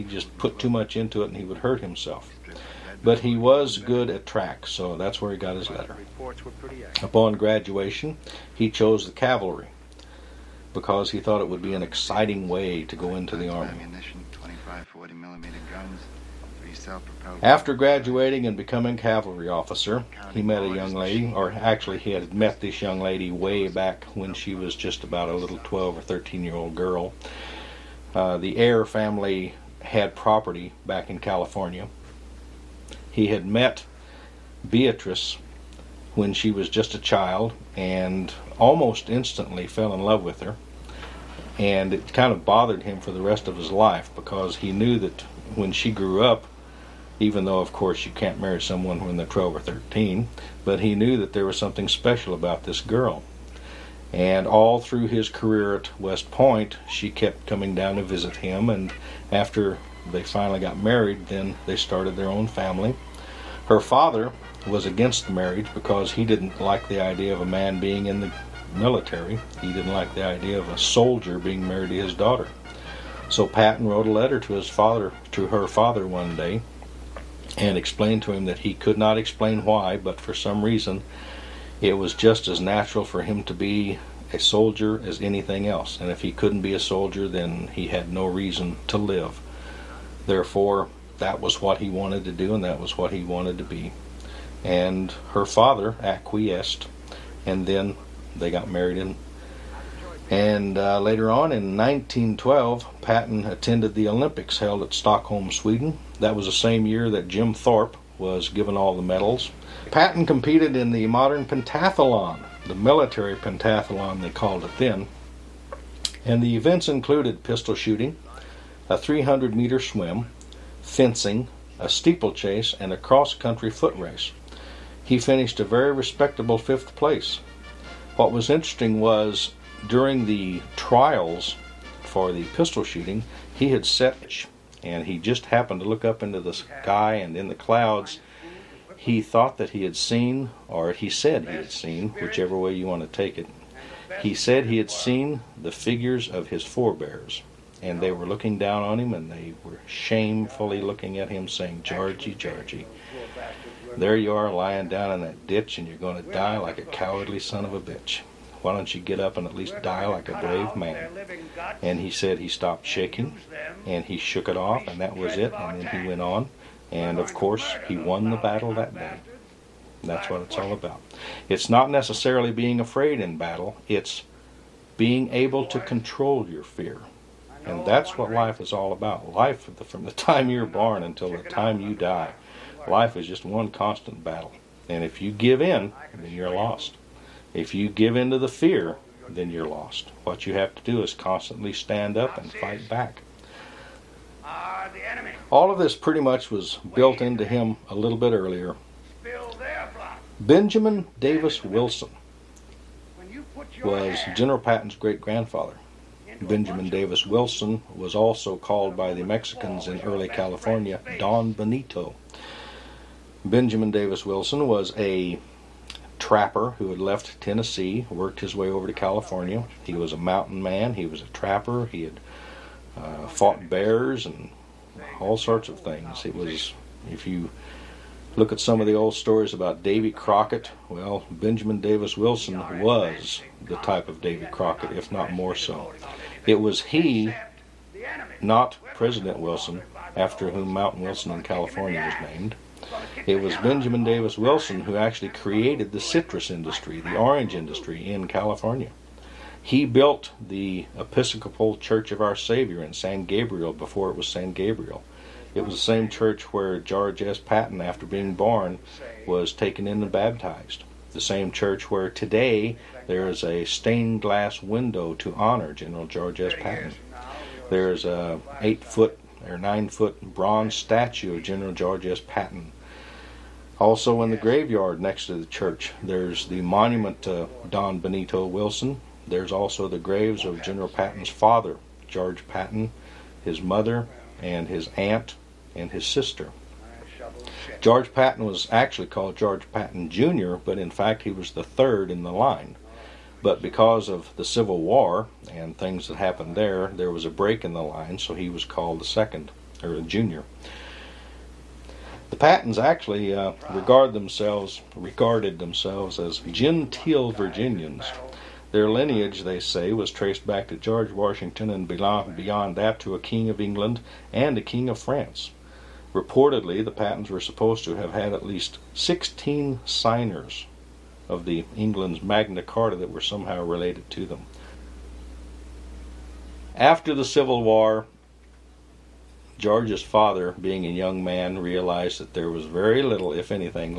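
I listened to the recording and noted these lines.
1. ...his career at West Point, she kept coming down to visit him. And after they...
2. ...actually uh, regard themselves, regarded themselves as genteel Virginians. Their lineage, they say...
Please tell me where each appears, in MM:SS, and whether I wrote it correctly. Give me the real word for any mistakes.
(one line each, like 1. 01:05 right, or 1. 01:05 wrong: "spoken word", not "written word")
1. 00:55 right
2. 05:02 right.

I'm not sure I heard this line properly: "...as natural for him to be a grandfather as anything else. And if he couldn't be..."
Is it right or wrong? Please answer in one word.
wrong.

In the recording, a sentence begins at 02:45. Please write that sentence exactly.
And then he went on, and of course, he won the battle that day.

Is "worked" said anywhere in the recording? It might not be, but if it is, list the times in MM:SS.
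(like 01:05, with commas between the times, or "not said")
03:38.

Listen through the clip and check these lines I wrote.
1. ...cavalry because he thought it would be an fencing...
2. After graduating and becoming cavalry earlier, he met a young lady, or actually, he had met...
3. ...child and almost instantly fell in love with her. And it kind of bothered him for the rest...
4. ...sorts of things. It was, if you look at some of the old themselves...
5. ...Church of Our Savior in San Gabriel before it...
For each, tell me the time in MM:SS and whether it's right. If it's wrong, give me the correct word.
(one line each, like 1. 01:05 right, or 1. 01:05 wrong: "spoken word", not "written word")
1. 00:09 wrong: "exciting", not "fencing"
2. 00:17 wrong: "officer", not "earlier"
3. 00:36 right
4. 03:45 wrong: "stories", not "themselves"
5. 04:11 right.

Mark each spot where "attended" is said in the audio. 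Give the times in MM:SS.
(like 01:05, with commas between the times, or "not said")
01:43.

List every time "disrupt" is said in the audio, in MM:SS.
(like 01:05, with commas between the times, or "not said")
not said.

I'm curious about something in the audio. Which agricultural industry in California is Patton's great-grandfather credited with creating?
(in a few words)
Citrus industry.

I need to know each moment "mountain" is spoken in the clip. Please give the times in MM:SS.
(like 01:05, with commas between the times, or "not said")
03:40, 04:00.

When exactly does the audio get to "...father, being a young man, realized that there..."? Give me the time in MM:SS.
05:30.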